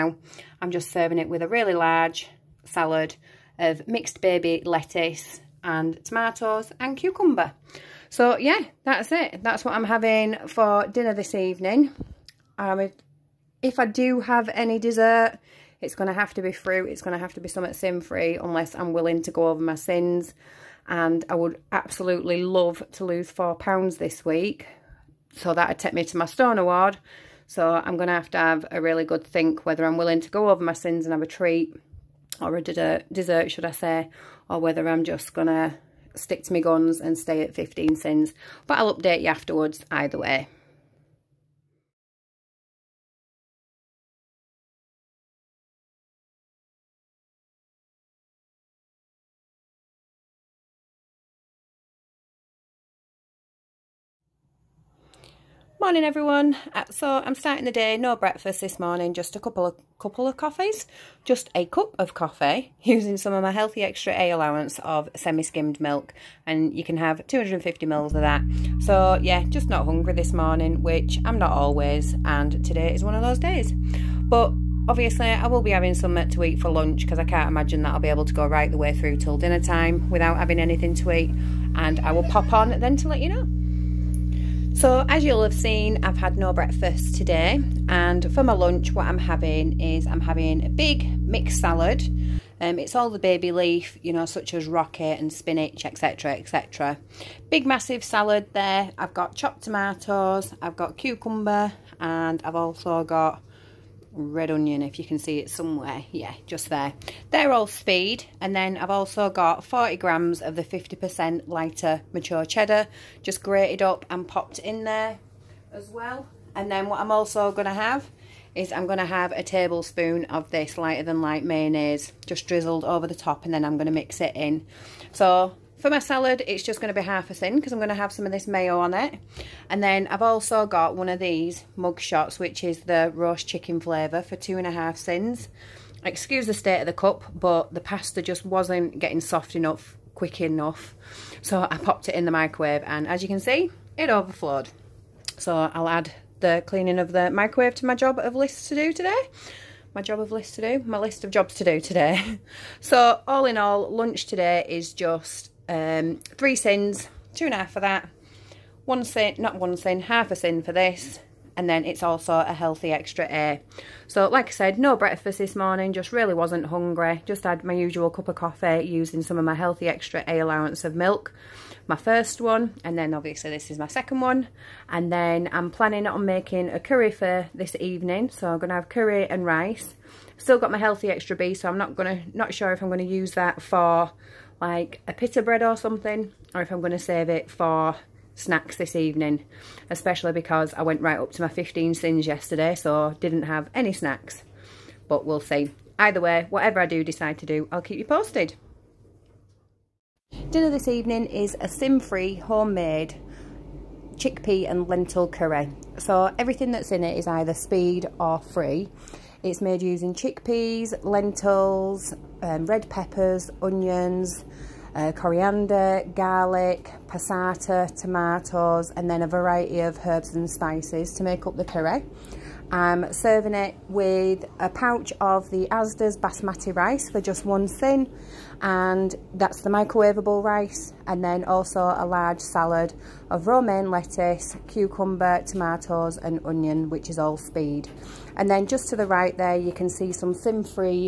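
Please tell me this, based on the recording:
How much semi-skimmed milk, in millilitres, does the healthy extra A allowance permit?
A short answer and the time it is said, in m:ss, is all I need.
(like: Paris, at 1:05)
250, at 1:07.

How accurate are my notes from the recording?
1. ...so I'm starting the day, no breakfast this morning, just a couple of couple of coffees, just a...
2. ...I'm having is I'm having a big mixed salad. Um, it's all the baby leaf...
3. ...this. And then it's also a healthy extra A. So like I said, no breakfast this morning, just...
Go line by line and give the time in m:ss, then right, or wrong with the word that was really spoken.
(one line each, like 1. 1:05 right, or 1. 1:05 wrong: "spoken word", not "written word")
1. 0:56 right
2. 1:29 right
3. 2:40 right.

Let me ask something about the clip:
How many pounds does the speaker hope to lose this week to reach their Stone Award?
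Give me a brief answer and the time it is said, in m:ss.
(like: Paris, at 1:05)
4, at 0:23.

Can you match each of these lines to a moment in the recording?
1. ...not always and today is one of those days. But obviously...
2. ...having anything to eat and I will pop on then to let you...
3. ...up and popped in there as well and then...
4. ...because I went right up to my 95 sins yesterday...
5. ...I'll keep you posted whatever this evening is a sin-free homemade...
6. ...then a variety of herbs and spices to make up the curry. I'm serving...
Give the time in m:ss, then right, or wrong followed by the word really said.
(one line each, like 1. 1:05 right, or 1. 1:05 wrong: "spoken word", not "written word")
1. 1:11 right
2. 1:20 right
3. 1:53 right
4. 3:10 wrong: "15", not "95"
5. 3:17 wrong: "dinner", not "whatever"
6. 3:39 right.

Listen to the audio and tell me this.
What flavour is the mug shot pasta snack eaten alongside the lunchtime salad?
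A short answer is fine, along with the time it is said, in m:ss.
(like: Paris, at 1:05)
Roast chicken, at 2:13.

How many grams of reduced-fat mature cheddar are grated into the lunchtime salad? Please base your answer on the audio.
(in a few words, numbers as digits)
40.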